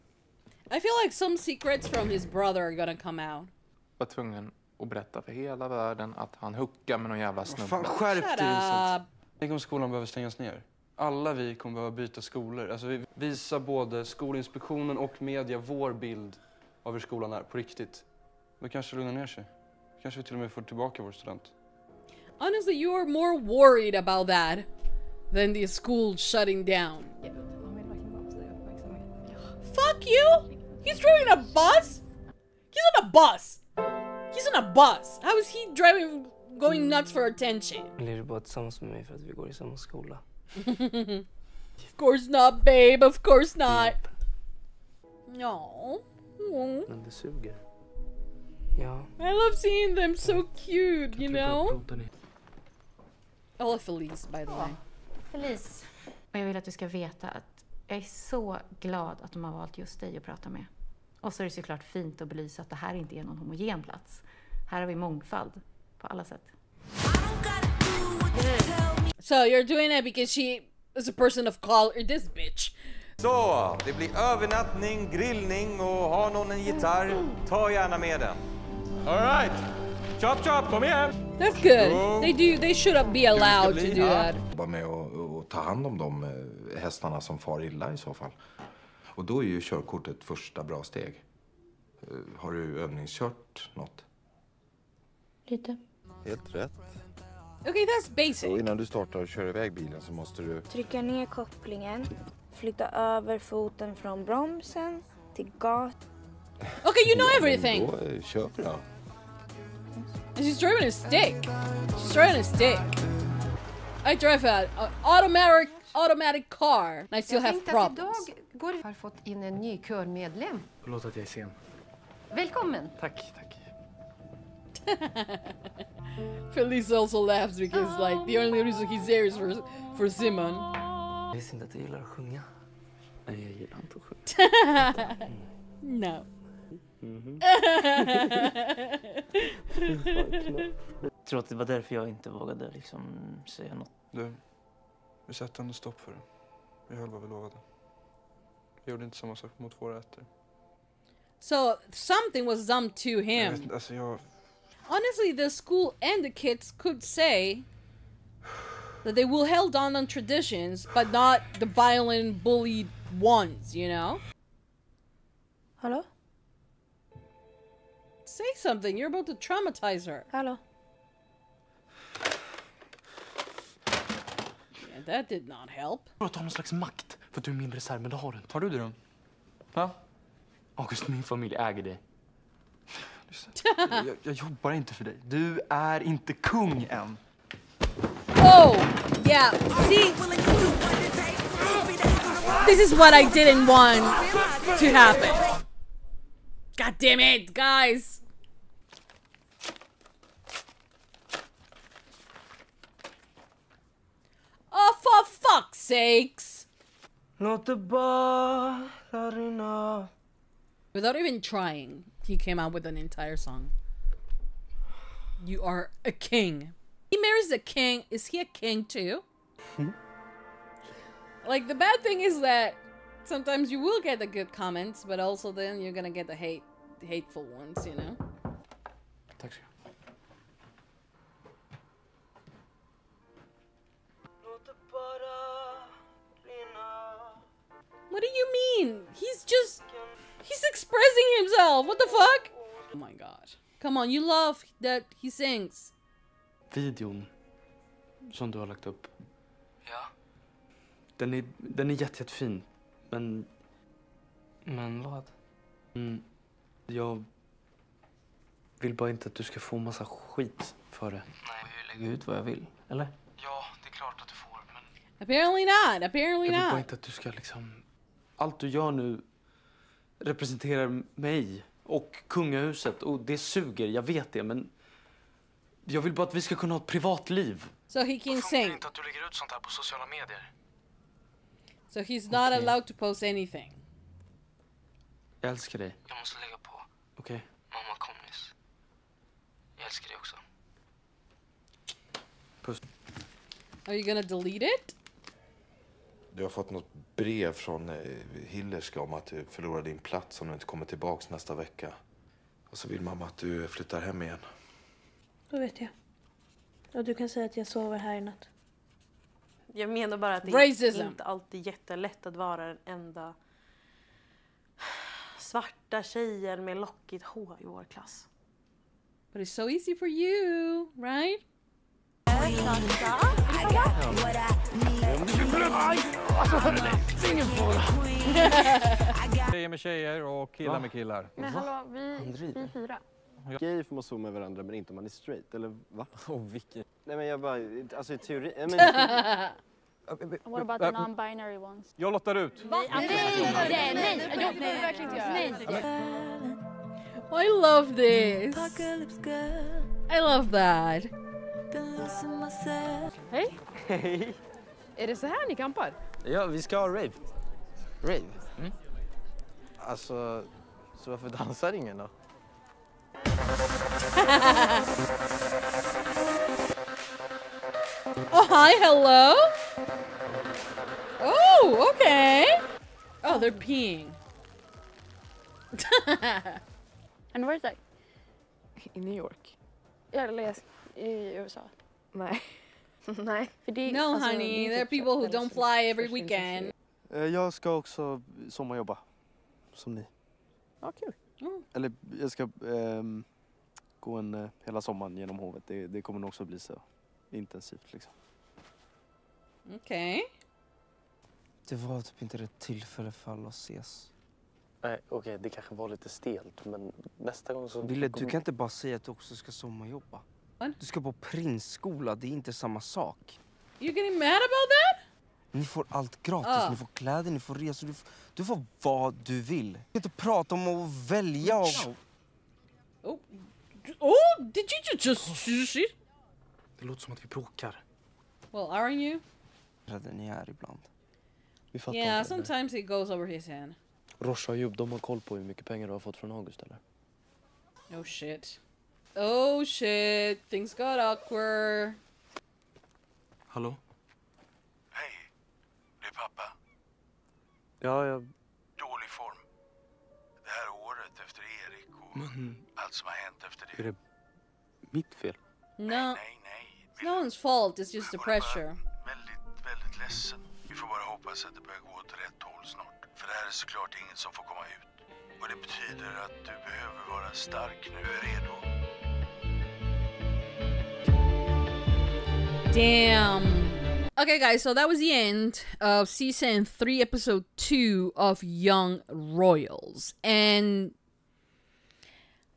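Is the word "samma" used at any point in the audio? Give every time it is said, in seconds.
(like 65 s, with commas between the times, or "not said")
149 s, 412 s.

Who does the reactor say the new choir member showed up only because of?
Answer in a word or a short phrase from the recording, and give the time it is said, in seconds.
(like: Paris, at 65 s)
Simon, at 130 s.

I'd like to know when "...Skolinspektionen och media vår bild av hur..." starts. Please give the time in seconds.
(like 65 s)
14 s.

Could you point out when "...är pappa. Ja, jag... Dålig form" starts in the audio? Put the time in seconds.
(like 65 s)
446 s.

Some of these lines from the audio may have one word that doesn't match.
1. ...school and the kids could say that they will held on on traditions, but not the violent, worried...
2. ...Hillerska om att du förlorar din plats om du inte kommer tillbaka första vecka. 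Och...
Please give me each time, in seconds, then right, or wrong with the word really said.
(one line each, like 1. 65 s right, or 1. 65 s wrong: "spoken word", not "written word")
1. 155 s wrong: "bullied", not "worried"
2. 298 s wrong: "nästa", not "första".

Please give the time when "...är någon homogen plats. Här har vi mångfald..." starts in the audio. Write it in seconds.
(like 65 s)
63 s.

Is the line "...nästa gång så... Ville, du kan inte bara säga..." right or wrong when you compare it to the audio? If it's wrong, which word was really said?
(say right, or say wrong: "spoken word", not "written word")
right.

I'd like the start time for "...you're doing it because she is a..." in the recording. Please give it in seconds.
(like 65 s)
69 s.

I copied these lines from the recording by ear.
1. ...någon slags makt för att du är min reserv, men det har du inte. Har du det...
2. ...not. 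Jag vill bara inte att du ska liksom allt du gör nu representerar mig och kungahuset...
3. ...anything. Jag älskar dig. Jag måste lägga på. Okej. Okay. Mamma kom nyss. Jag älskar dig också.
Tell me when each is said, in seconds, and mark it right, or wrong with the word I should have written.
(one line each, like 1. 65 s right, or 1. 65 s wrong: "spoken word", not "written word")
1. 176 s right
2. 266 s right
3. 283 s right.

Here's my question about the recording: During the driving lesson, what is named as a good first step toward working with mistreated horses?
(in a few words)
Körkortet.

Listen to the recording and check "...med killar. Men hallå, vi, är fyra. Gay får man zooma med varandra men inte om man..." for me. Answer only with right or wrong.
right.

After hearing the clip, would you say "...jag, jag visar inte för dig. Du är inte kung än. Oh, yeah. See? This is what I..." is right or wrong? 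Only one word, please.
wrong.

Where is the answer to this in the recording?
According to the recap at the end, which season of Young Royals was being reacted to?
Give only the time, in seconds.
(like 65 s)
476 s.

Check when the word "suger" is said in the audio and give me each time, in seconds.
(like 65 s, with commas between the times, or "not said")
273 s.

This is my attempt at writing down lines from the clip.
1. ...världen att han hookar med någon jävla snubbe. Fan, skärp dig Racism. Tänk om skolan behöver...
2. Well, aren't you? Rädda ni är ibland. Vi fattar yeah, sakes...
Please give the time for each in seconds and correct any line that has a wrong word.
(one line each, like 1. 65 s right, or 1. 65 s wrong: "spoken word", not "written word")
1. 5 s wrong: "Vincent", not "Racism"
2. 428 s wrong: "sometimes", not "sakes".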